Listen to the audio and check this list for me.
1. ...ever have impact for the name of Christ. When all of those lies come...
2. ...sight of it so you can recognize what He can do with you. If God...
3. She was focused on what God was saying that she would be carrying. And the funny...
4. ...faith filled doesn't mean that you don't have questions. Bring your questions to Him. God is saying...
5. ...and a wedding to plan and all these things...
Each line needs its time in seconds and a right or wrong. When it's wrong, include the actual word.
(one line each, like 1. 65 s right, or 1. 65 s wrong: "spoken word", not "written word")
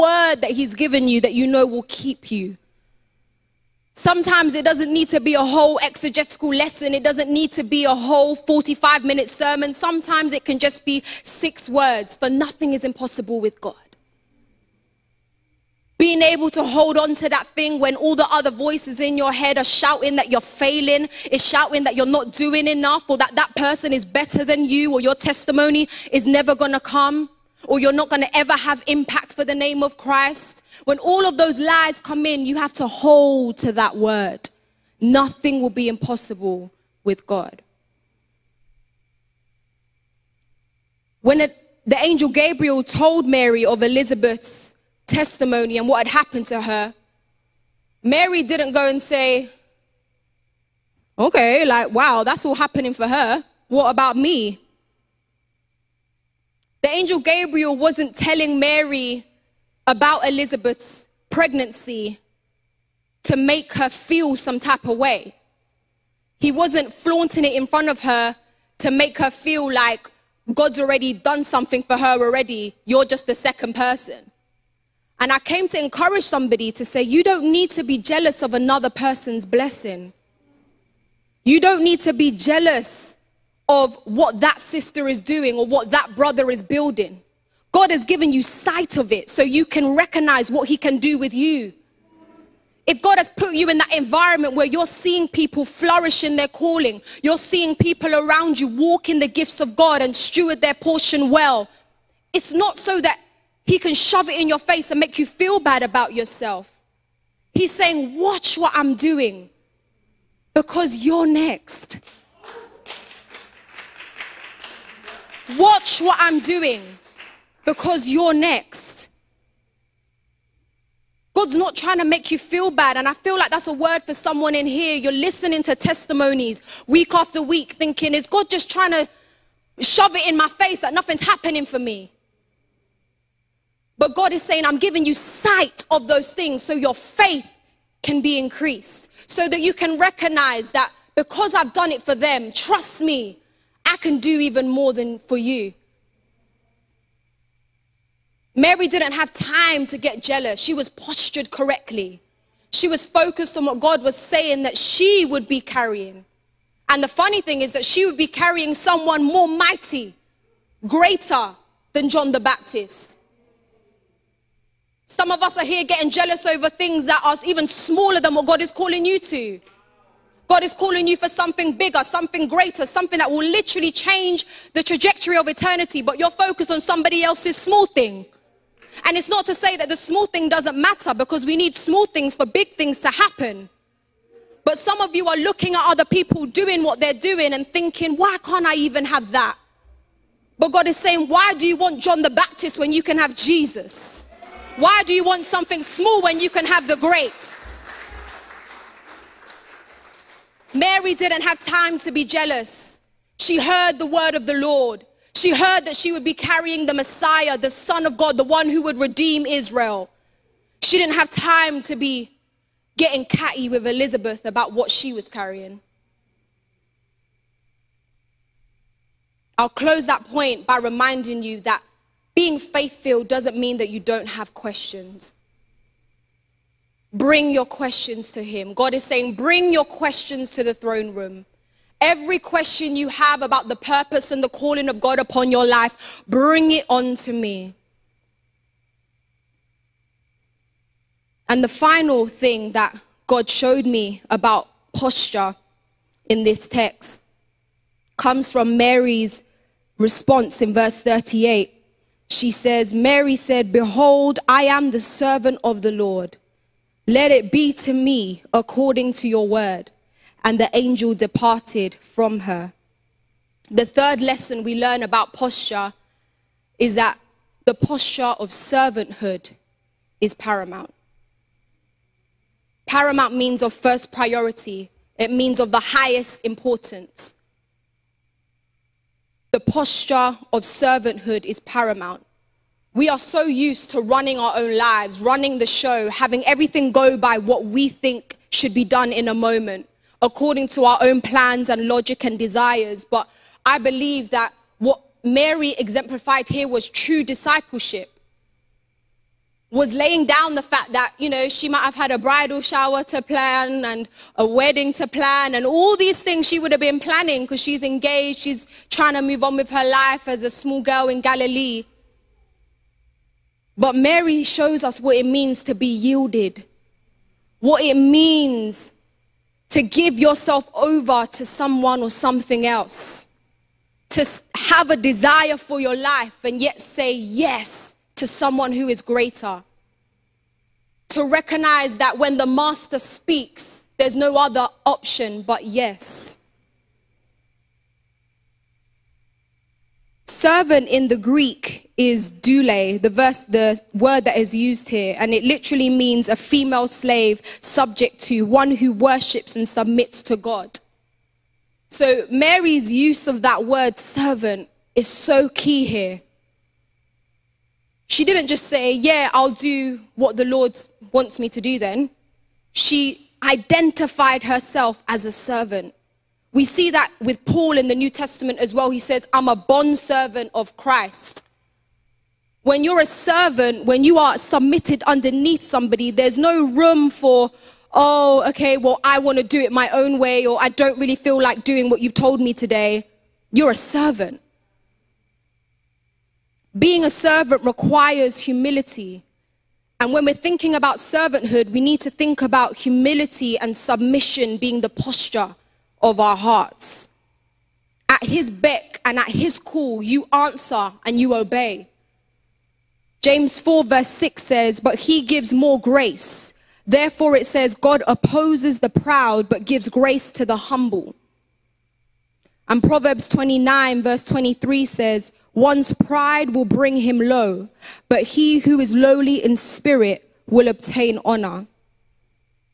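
1. 28 s right
2. 88 s right
3. 152 s right
4. 222 s right
5. 303 s right.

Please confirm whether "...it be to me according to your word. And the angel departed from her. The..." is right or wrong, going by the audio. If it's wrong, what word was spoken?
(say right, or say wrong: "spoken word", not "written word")
right.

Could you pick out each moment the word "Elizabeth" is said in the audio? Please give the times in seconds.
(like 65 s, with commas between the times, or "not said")
43 s, 60 s, 213 s.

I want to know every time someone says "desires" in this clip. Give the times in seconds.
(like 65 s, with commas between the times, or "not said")
292 s, 324 s.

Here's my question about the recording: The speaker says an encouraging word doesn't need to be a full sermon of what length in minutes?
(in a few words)
45.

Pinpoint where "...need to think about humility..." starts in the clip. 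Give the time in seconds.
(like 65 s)
391 s.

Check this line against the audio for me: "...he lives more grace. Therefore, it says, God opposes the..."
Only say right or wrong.
wrong.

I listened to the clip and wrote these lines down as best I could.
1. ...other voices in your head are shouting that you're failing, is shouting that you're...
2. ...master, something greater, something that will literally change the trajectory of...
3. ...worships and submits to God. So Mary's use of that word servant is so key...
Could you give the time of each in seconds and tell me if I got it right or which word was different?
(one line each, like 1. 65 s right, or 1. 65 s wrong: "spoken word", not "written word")
1. 18 s right
2. 171 s wrong: "bigger", not "master"
3. 348 s right.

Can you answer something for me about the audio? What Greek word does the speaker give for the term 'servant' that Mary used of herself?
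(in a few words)
doule.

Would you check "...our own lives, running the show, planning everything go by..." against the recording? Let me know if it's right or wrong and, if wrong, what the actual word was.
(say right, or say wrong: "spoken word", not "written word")
wrong: "having", not "planning".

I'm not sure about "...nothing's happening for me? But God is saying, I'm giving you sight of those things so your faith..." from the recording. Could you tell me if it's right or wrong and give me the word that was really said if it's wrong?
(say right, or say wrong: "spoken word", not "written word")
right.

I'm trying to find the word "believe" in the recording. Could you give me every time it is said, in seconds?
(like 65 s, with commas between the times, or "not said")
293 s.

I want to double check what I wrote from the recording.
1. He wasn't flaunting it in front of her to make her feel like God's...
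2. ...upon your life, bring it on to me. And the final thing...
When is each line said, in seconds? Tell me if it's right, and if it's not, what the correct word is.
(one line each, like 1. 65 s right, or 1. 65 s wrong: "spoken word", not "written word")
1. 66 s right
2. 235 s right.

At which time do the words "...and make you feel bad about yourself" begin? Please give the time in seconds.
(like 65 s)
104 s.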